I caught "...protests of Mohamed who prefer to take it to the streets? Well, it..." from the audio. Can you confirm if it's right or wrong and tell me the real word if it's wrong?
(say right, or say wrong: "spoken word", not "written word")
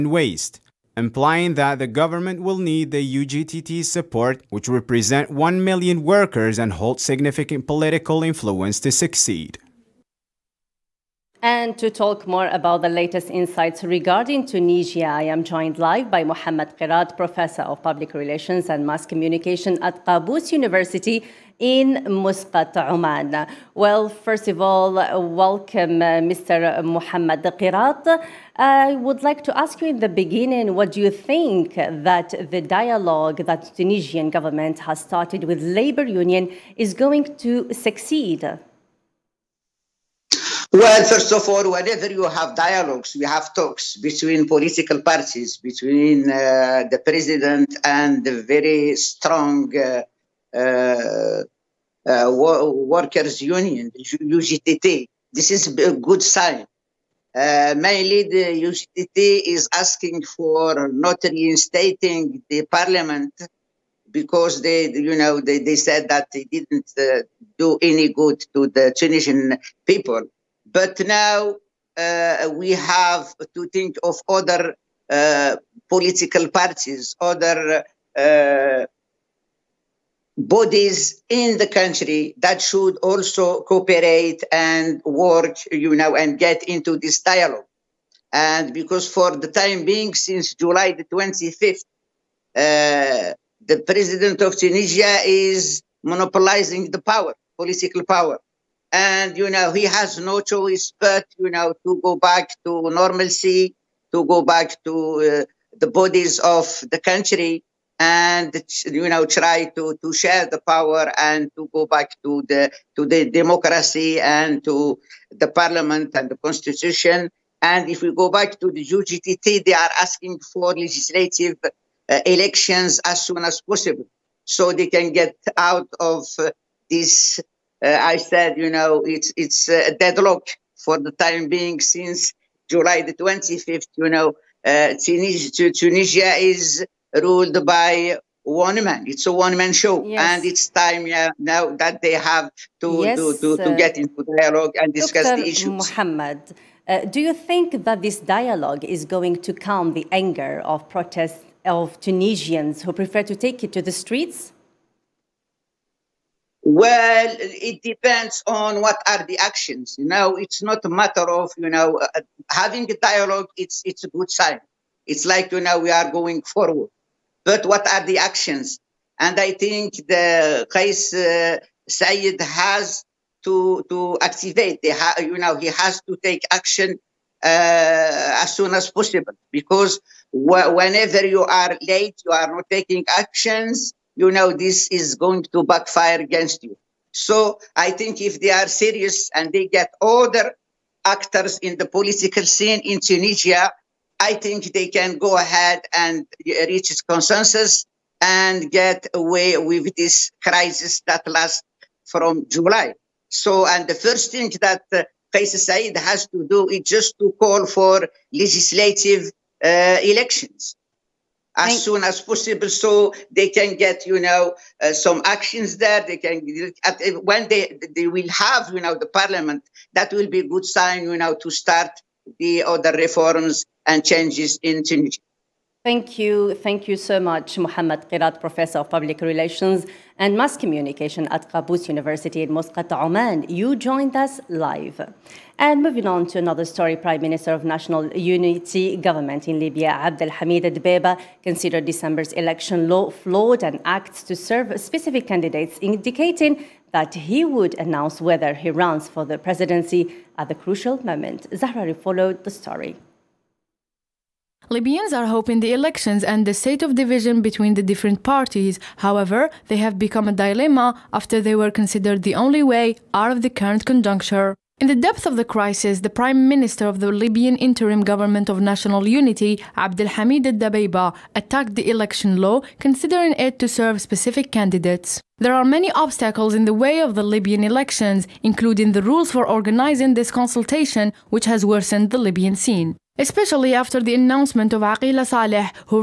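wrong: "Tunisians", not "Mohamed".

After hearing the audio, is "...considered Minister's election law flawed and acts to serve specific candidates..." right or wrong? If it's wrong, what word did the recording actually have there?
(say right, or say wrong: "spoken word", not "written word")
wrong: "December", not "Minister".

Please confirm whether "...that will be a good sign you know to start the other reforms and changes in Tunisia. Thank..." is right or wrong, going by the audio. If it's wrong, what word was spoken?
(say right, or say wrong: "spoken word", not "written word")
right.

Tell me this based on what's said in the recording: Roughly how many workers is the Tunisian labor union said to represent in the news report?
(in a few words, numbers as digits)
1 million.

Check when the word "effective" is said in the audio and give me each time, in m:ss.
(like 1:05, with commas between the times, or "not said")
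not said.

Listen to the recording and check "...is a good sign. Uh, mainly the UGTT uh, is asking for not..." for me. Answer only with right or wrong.
right.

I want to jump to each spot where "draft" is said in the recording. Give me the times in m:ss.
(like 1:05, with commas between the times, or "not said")
not said.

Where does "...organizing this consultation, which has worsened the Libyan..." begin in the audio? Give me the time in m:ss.
4:39.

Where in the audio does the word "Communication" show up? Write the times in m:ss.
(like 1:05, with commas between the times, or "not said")
0:19, 3:50.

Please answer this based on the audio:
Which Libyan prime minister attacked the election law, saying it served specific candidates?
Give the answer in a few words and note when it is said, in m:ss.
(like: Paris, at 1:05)
Abdelhamid Dabeiba, at 4:29.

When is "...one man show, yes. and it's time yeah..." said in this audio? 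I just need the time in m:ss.
2:19.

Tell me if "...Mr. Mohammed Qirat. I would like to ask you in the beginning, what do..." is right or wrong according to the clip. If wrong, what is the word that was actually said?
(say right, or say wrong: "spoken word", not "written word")
right.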